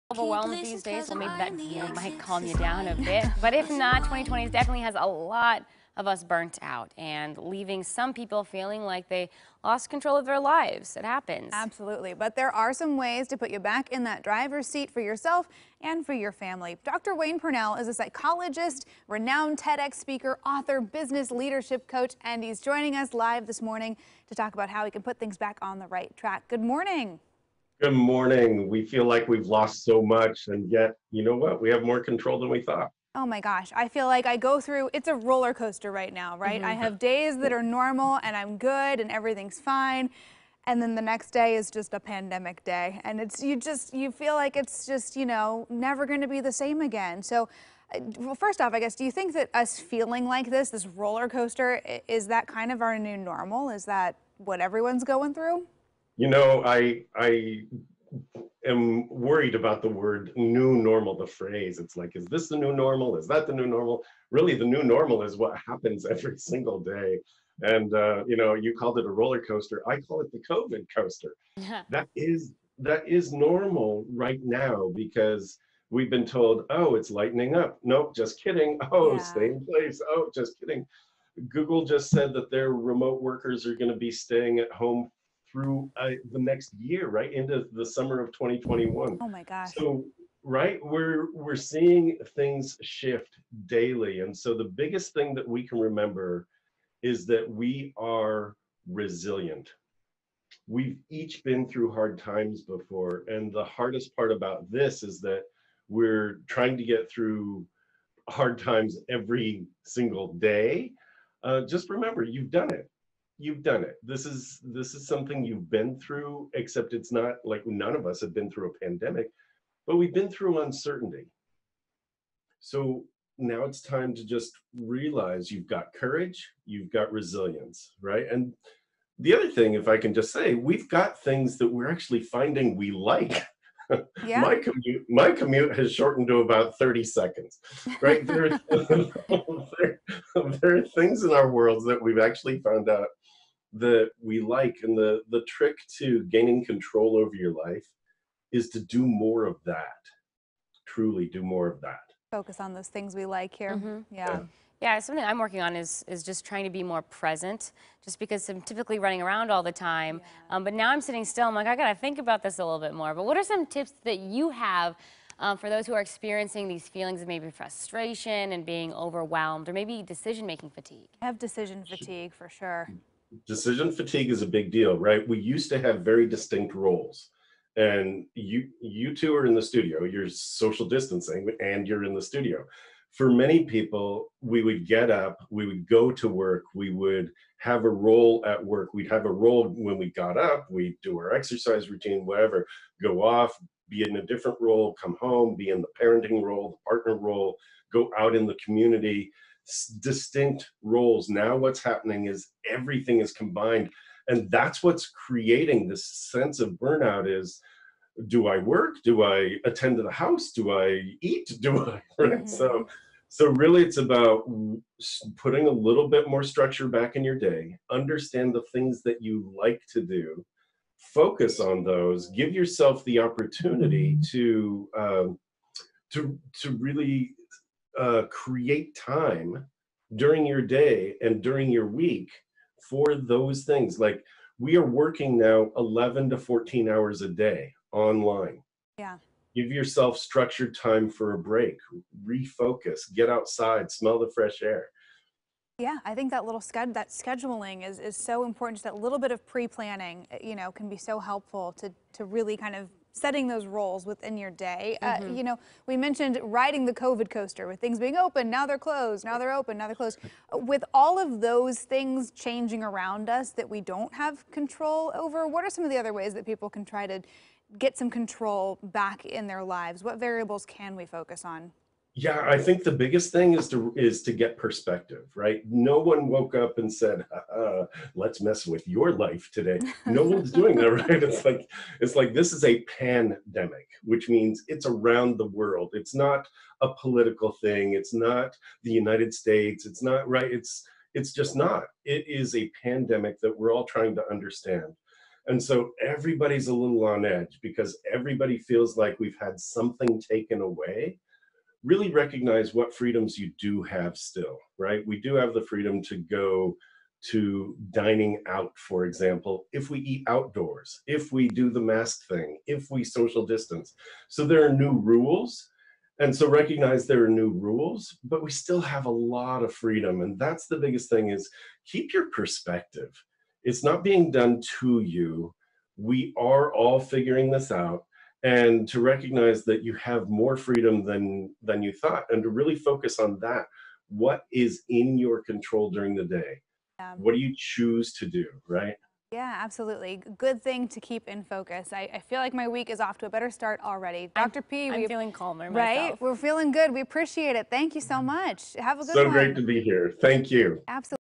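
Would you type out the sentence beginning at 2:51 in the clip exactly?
I have decision fatigue for sure.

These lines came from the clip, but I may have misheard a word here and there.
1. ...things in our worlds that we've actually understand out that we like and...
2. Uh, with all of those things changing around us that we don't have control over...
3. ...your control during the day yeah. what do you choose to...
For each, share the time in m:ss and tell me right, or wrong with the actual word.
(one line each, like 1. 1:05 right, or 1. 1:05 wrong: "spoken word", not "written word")
1. 2:20 wrong: "found", not "understand"
2. 4:20 right
3. 5:35 right.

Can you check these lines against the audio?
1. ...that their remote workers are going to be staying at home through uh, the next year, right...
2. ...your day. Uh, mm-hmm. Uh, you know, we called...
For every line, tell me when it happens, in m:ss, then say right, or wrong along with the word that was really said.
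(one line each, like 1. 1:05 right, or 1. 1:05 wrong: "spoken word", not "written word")
1. 1:22 right
2. 4:14 wrong: "mentioned", not "called".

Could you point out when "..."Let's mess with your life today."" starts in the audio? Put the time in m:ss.
4:38.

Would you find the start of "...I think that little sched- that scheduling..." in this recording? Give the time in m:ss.
4:06.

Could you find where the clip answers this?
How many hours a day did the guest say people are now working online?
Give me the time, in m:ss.
3:55.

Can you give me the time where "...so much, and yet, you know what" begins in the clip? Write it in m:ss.
0:29.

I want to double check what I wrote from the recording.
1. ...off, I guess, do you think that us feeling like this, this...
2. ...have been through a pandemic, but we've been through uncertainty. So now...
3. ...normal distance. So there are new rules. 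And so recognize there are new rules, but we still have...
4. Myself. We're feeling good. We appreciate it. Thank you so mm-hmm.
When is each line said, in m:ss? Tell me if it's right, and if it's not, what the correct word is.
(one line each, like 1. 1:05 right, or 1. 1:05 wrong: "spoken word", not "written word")
1. 0:48 right
2. 1:58 right
3. 5:13 wrong: "social", not "normal"
4. 5:46 right.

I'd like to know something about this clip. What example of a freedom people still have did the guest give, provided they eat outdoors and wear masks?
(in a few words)
dining out.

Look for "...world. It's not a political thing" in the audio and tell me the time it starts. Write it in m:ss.
4:45.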